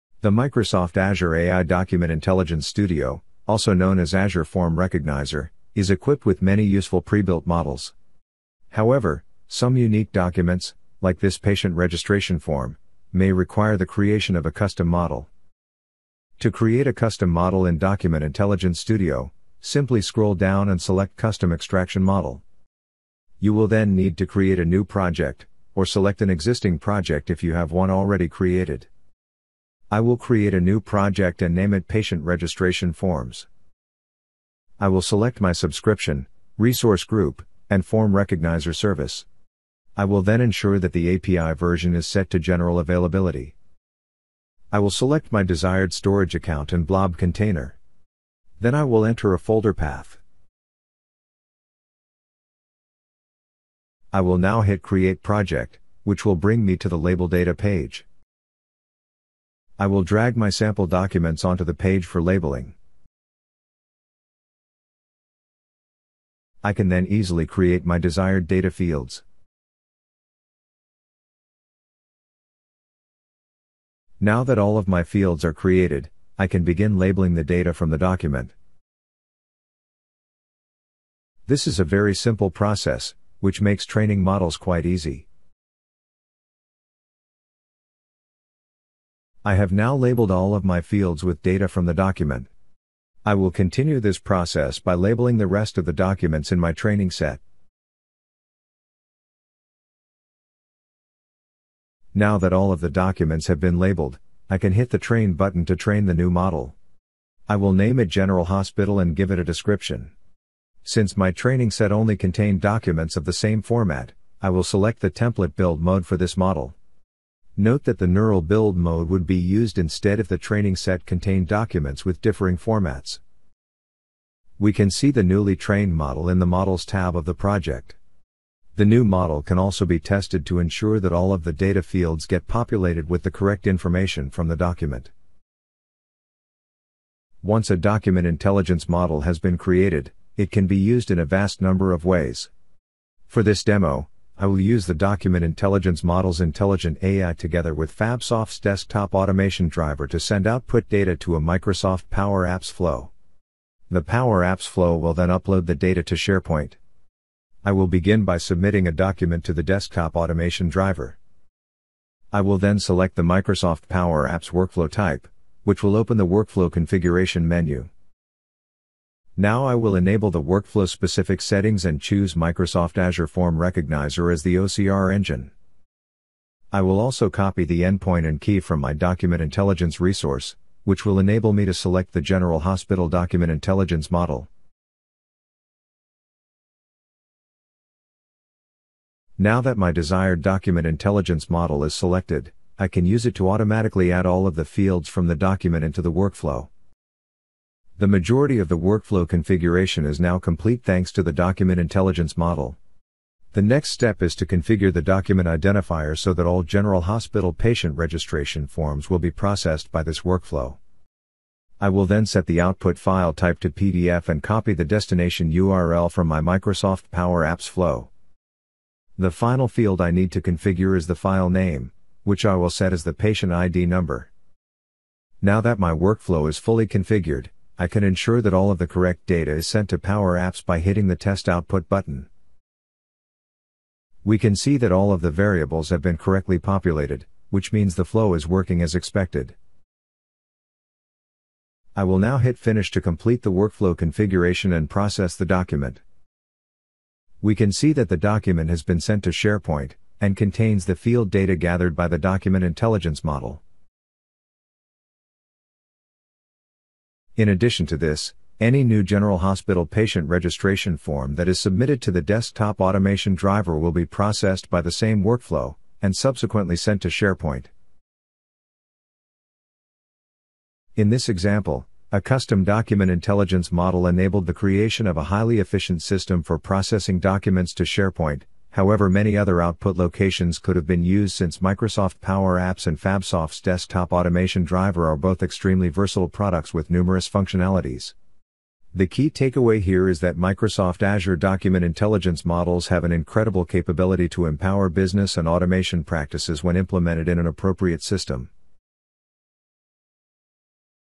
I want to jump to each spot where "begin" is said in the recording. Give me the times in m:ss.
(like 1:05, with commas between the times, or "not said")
1:16, 2:37.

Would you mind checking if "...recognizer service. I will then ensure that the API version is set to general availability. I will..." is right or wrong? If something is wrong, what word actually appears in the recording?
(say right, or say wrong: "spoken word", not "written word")
right.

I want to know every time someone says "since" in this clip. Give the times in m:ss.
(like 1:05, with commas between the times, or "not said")
1:50, 4:41.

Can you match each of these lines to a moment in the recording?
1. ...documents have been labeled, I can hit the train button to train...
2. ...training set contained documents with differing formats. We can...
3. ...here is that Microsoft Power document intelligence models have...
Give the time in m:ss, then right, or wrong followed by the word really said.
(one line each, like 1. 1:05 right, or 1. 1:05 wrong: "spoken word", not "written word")
1. 1:42 right
2. 2:00 right
3. 4:49 wrong: "Azure", not "Power".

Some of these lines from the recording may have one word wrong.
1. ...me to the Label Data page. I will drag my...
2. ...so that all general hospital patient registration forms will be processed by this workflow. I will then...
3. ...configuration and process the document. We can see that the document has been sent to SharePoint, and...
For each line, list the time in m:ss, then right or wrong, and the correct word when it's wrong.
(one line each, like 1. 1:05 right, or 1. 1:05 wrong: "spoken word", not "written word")
1. 0:56 right
2. 3:26 right
3. 4:03 right.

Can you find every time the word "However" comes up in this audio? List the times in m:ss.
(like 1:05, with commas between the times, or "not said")
0:08, 4:38.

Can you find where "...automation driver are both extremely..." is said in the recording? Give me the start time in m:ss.
4:44.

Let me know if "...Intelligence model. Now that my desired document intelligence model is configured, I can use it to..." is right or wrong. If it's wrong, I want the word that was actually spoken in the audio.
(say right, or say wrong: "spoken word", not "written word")
wrong: "selected", not "configured".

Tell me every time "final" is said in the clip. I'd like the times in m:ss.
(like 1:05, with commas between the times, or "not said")
3:39.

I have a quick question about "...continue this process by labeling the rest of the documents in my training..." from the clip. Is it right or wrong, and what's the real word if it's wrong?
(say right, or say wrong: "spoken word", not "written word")
right.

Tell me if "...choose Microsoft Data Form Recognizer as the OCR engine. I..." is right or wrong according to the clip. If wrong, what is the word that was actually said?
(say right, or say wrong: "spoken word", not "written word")
wrong: "Azure", not "Data".